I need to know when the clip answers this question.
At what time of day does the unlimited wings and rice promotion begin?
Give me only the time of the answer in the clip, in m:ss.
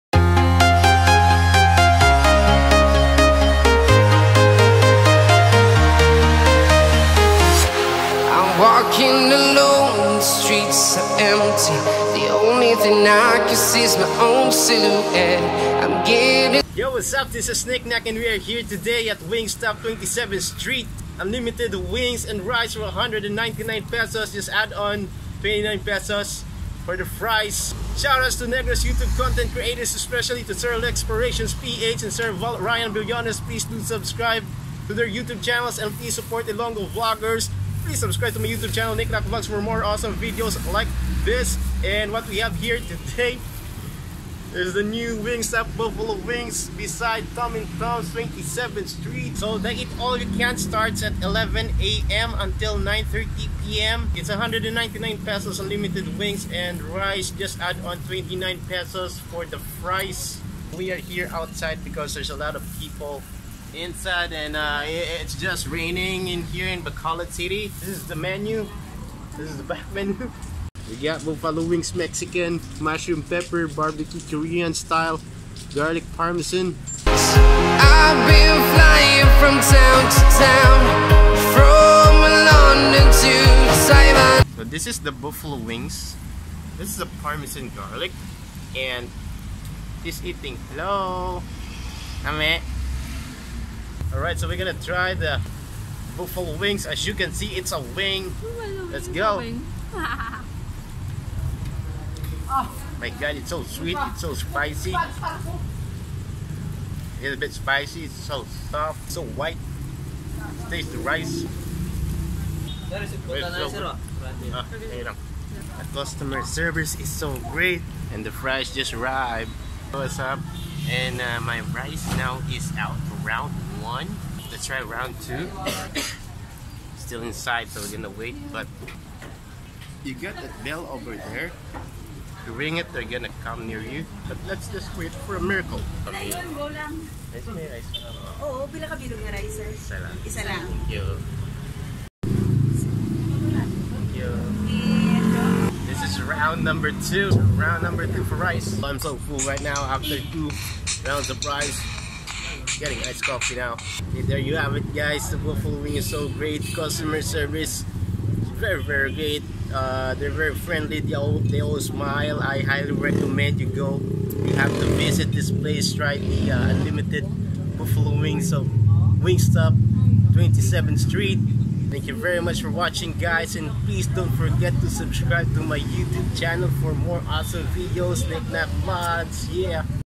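0:51.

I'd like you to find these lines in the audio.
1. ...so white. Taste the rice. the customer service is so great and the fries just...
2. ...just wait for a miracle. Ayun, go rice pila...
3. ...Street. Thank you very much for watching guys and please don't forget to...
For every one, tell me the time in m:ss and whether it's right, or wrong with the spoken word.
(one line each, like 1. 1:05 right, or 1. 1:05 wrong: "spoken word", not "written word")
1. 1:49 right
2. 2:14 right
3. 2:51 right.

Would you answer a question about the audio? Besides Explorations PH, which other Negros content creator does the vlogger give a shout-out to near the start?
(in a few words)
Ryan Billones.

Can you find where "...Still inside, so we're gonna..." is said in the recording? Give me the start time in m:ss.
2:06.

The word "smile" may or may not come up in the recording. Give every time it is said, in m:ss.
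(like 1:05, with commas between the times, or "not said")
2:41.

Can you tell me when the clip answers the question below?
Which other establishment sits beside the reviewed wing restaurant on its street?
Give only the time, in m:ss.
0:47.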